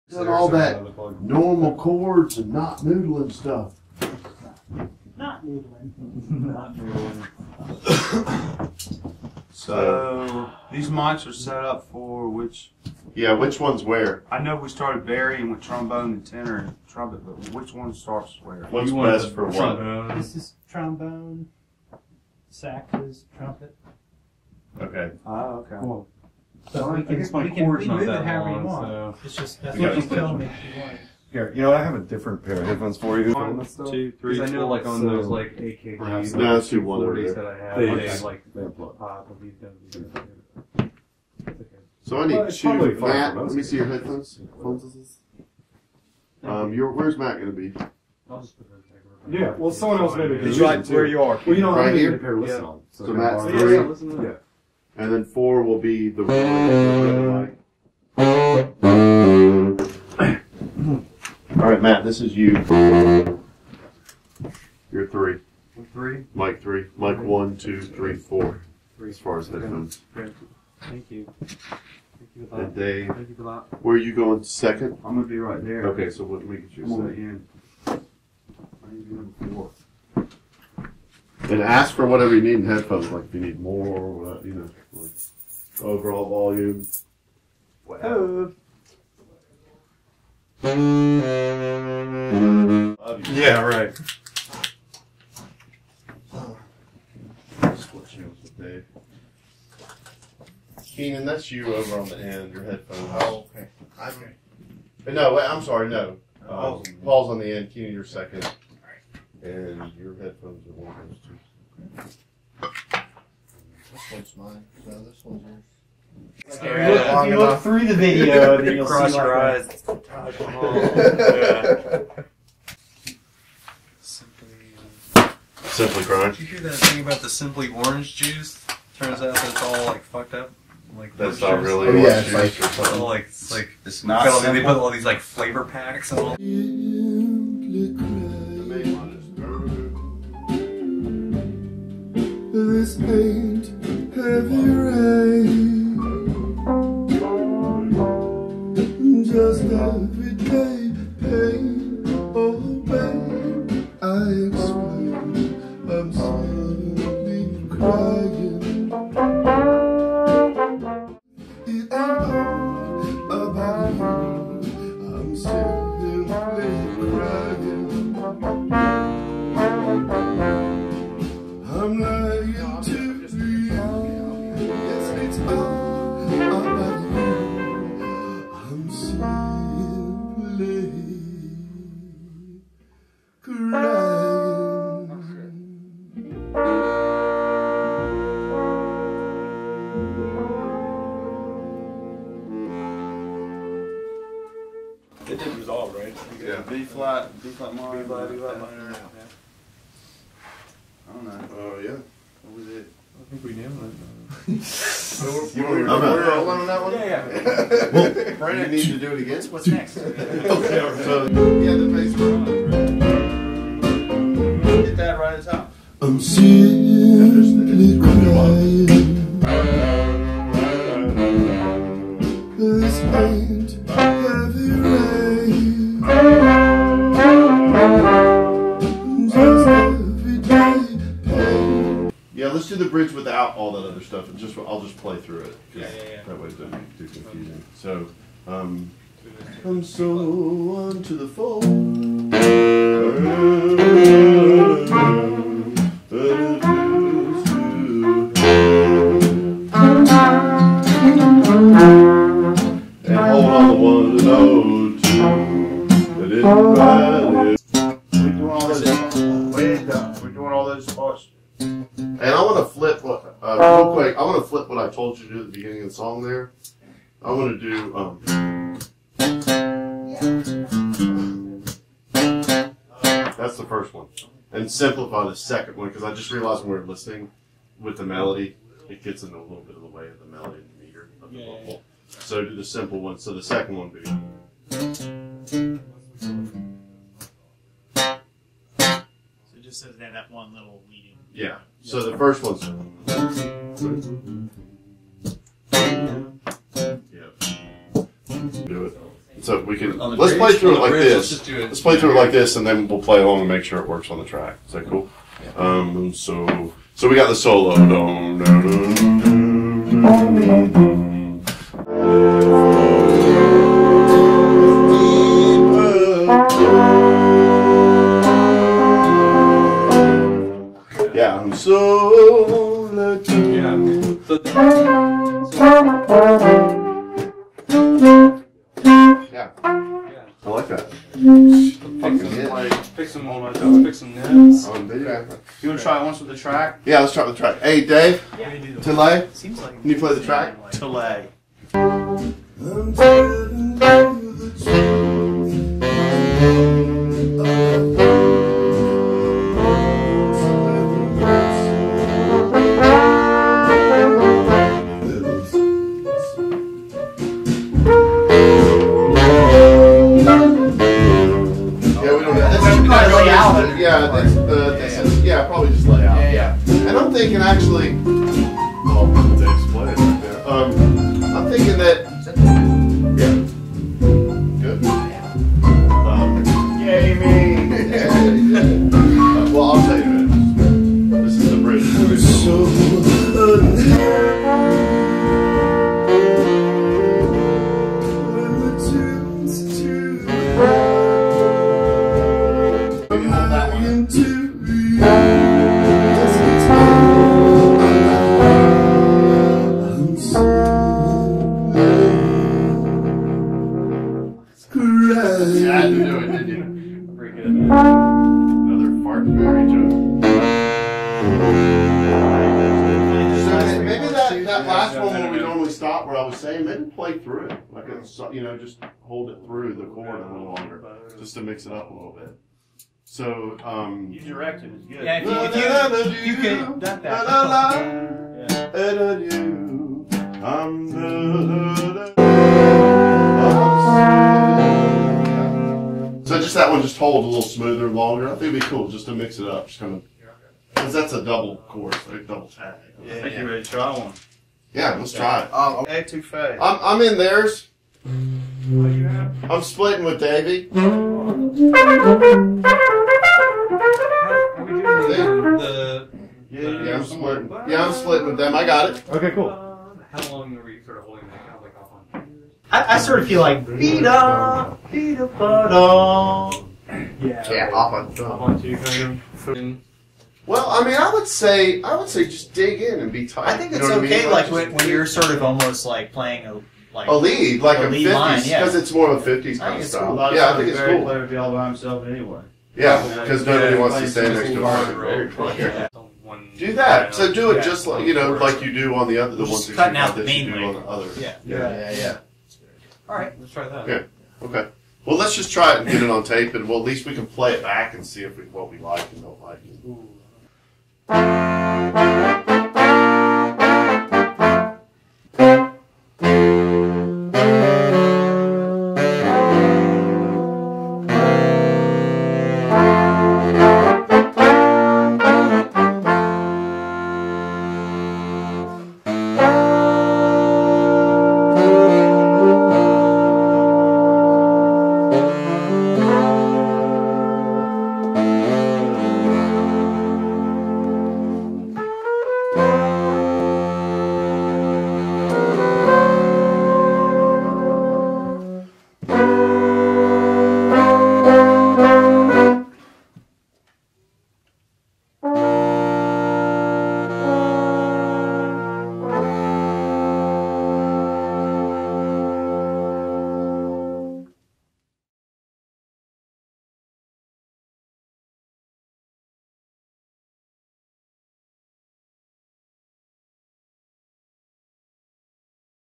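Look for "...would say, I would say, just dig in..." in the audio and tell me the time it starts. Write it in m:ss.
7:51.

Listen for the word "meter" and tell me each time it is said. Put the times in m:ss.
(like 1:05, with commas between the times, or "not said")
4:40.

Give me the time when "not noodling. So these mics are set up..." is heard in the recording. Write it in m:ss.
0:06.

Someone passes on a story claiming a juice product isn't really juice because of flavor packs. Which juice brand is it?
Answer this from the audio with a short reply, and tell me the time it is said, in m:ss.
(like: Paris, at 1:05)
Simply Orange, at 2:07.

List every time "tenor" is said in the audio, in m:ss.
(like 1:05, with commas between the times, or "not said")
0:16.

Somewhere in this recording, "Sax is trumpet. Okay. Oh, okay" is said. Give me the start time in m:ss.
0:22.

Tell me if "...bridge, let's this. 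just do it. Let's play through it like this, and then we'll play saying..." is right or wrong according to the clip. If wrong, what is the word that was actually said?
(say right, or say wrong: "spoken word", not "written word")
wrong: "along", not "saying".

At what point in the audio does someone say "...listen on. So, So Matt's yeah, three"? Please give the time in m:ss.
0:52.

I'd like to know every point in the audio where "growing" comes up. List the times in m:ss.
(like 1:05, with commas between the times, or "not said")
not said.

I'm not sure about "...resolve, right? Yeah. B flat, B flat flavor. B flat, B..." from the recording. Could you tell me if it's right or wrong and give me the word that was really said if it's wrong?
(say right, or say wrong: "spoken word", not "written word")
wrong: "minor", not "flavor".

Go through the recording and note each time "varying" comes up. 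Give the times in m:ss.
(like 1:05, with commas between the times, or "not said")
0:15.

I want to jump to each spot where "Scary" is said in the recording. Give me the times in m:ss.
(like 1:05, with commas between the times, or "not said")
1:56.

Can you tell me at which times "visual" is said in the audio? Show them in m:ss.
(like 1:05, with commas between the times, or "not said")
not said.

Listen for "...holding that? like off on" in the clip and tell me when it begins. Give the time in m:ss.
7:41.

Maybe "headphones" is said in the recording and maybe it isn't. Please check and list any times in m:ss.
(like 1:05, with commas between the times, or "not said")
0:32, 0:43, 1:09, 1:22, 1:42, 1:50.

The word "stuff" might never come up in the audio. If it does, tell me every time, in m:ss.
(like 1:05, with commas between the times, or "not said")
0:03, 3:54.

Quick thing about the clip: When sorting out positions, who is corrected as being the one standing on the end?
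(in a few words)
Paul.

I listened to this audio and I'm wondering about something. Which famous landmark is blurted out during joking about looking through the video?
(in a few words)
Taj Mahal.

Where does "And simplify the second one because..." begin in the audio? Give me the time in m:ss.
4:34.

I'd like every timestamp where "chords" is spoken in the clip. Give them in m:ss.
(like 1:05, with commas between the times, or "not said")
0:01, 6:59.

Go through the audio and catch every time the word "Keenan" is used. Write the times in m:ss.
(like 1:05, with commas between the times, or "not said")
1:40, 1:47.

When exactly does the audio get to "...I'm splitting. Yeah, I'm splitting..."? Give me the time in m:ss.
7:36.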